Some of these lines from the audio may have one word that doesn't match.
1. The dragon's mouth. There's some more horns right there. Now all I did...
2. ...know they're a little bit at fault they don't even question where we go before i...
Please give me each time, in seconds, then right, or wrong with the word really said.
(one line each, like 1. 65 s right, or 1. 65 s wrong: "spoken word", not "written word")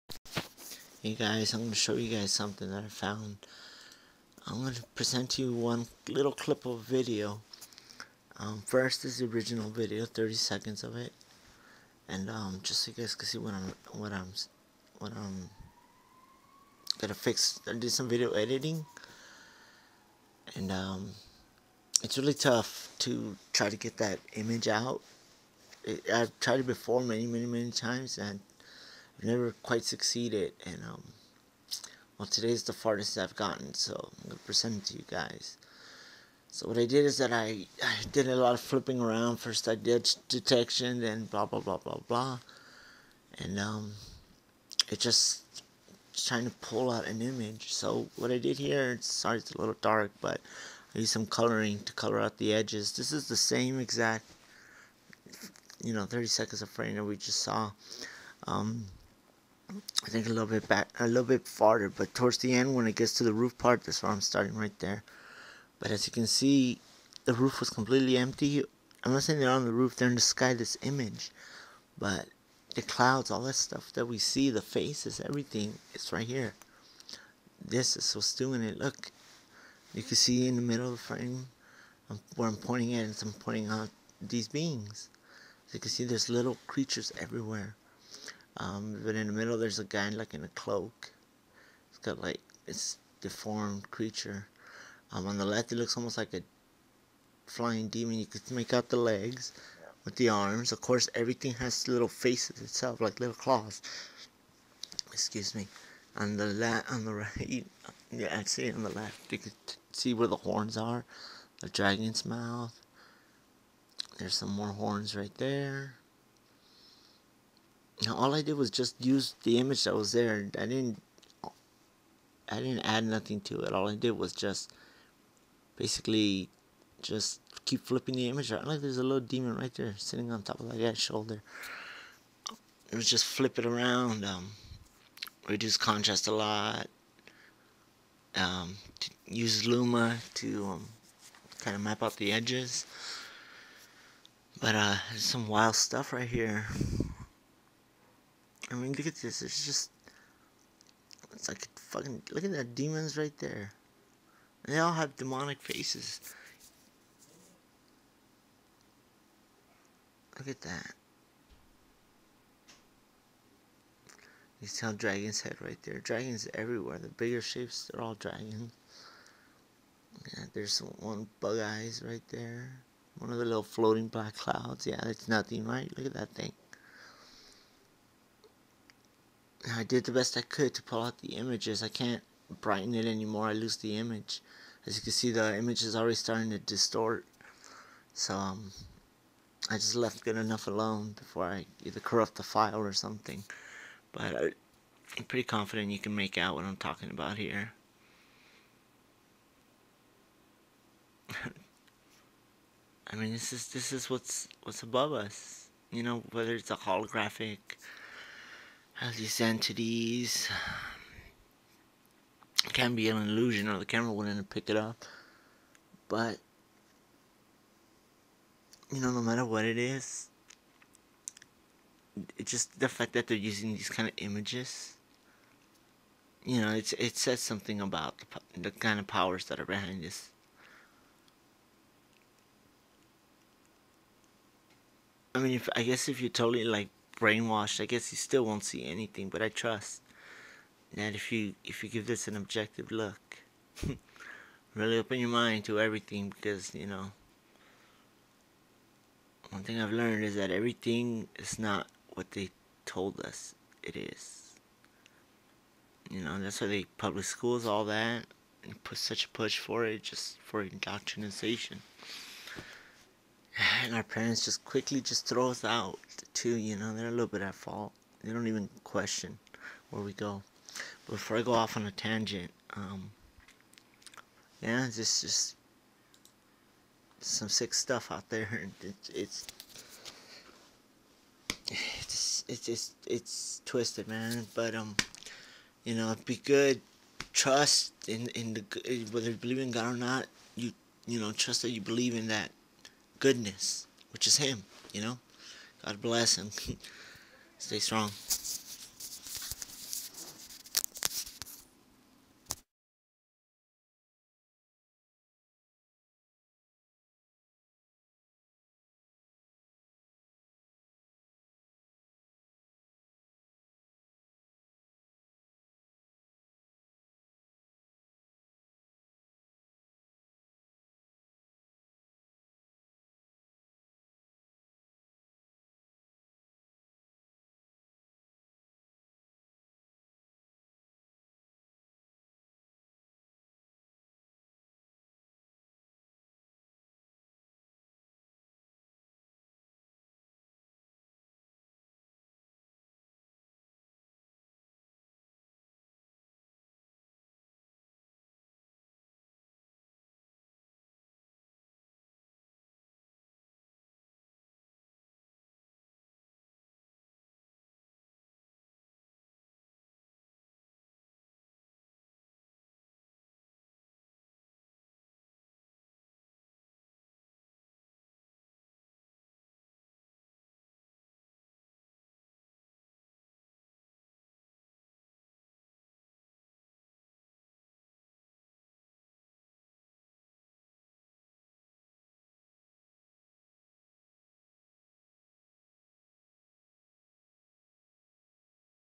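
1. 111 s right
2. 266 s right.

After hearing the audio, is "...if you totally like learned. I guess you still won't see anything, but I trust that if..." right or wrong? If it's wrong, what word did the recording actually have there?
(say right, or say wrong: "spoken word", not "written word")
wrong: "brainwashed", not "learned".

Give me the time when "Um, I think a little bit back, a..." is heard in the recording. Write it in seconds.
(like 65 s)
58 s.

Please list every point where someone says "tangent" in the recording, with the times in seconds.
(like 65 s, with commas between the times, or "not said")
271 s.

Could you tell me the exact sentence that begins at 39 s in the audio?
First I did detection, then blah, blah, blah, blah, blah.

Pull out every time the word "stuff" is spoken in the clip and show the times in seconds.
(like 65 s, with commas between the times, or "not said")
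73 s, 145 s, 277 s.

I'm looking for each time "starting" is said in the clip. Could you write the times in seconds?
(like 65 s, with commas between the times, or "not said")
64 s, 186 s.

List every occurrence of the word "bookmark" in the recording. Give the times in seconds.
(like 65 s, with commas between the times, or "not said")
not said.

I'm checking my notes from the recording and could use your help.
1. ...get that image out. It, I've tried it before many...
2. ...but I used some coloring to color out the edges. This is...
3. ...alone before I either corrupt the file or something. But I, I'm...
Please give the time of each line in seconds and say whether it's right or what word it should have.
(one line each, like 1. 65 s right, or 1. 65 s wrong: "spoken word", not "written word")
1. 23 s right
2. 50 s right
3. 190 s right.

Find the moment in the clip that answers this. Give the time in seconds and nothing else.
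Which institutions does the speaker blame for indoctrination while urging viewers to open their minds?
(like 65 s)
256 s.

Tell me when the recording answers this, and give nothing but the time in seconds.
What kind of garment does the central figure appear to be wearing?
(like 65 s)
90 s.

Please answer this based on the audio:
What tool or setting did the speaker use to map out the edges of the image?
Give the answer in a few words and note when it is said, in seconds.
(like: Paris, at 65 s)
Luma, at 139 s.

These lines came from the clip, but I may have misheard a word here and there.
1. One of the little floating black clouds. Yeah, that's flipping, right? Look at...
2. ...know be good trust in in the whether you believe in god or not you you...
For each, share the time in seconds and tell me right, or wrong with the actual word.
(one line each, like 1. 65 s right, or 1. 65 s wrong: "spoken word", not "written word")
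1. 173 s wrong: "nothing", not "flipping"
2. 285 s right.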